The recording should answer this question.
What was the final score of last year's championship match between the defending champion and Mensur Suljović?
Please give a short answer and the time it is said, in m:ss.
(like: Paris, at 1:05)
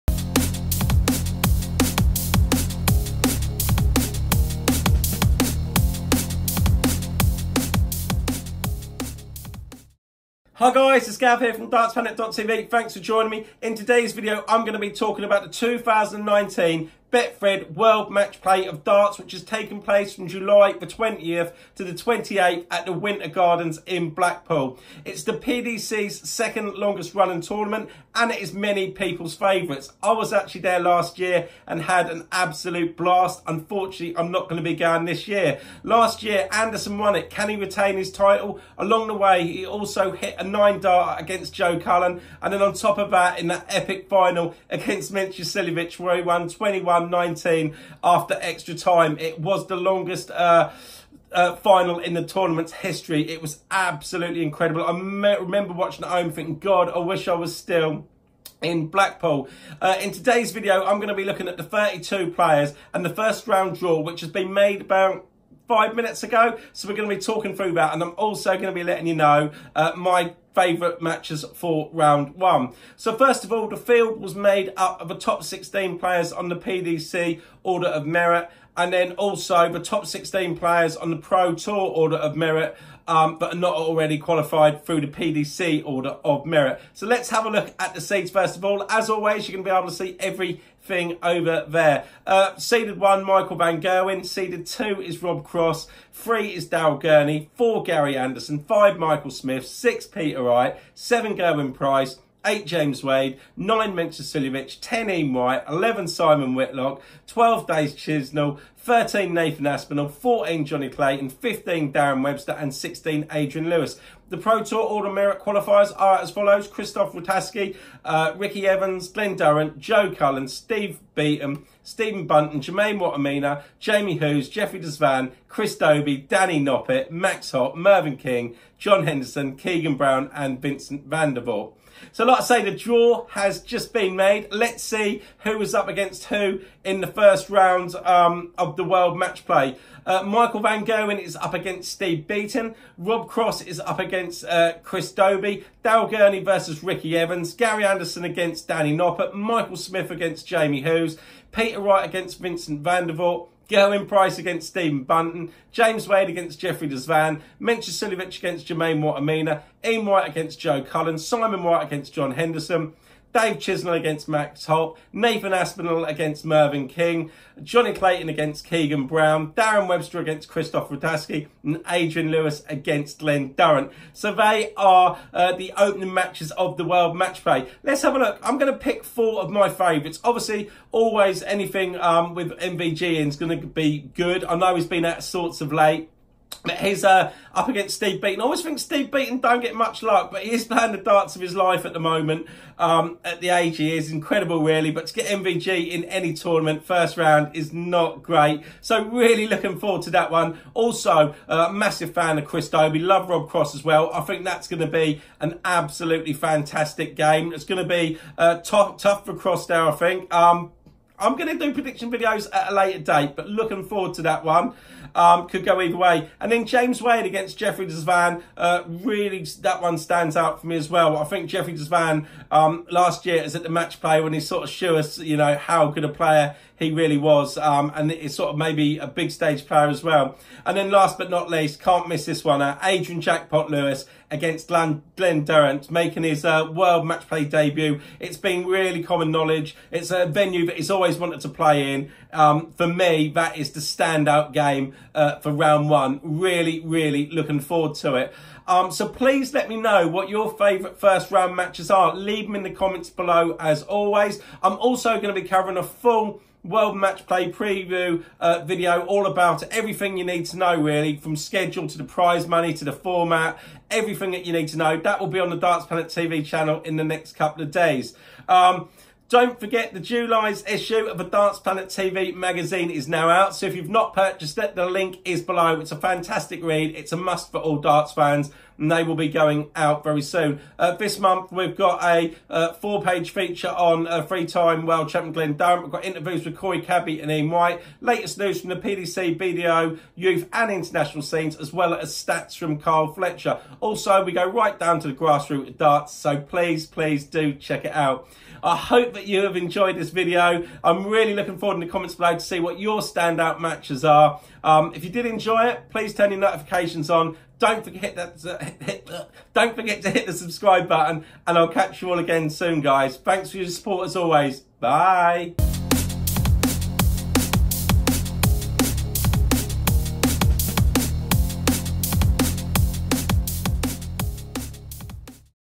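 21-19, at 0:46.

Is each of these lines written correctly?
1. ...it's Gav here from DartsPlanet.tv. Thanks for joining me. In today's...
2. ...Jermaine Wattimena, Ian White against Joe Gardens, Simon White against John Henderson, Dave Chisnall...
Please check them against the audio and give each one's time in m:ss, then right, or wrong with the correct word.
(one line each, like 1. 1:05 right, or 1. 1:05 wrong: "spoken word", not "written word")
1. 0:11 right
2. 2:38 wrong: "Cullen", not "Gardens".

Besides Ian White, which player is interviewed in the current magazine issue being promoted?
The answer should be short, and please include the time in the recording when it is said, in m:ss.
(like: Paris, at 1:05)
Corey Cadby, at 4:46.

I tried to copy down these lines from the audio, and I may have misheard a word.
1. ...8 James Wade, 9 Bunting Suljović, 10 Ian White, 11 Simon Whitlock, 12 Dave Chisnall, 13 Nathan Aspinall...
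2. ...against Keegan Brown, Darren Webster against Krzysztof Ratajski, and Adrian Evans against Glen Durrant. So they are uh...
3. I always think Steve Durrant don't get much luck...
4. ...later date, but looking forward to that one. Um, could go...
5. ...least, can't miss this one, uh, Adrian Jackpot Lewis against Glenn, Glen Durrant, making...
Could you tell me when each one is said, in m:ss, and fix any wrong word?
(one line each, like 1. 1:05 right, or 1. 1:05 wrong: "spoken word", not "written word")
1. 1:42 wrong: "Mensur", not "Bunting"
2. 2:48 wrong: "Lewis", not "Evans"
3. 3:08 wrong: "Beaton", not "Durrant"
4. 3:32 right
5. 3:51 right.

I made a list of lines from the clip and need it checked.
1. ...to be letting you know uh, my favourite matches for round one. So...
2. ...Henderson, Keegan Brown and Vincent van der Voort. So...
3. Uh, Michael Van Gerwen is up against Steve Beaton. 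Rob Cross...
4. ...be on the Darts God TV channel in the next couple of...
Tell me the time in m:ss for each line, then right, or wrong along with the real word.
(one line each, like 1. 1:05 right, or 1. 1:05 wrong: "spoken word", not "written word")
1. 1:08 right
2. 2:09 right
3. 2:20 right
4. 4:25 wrong: "Planet", not "God".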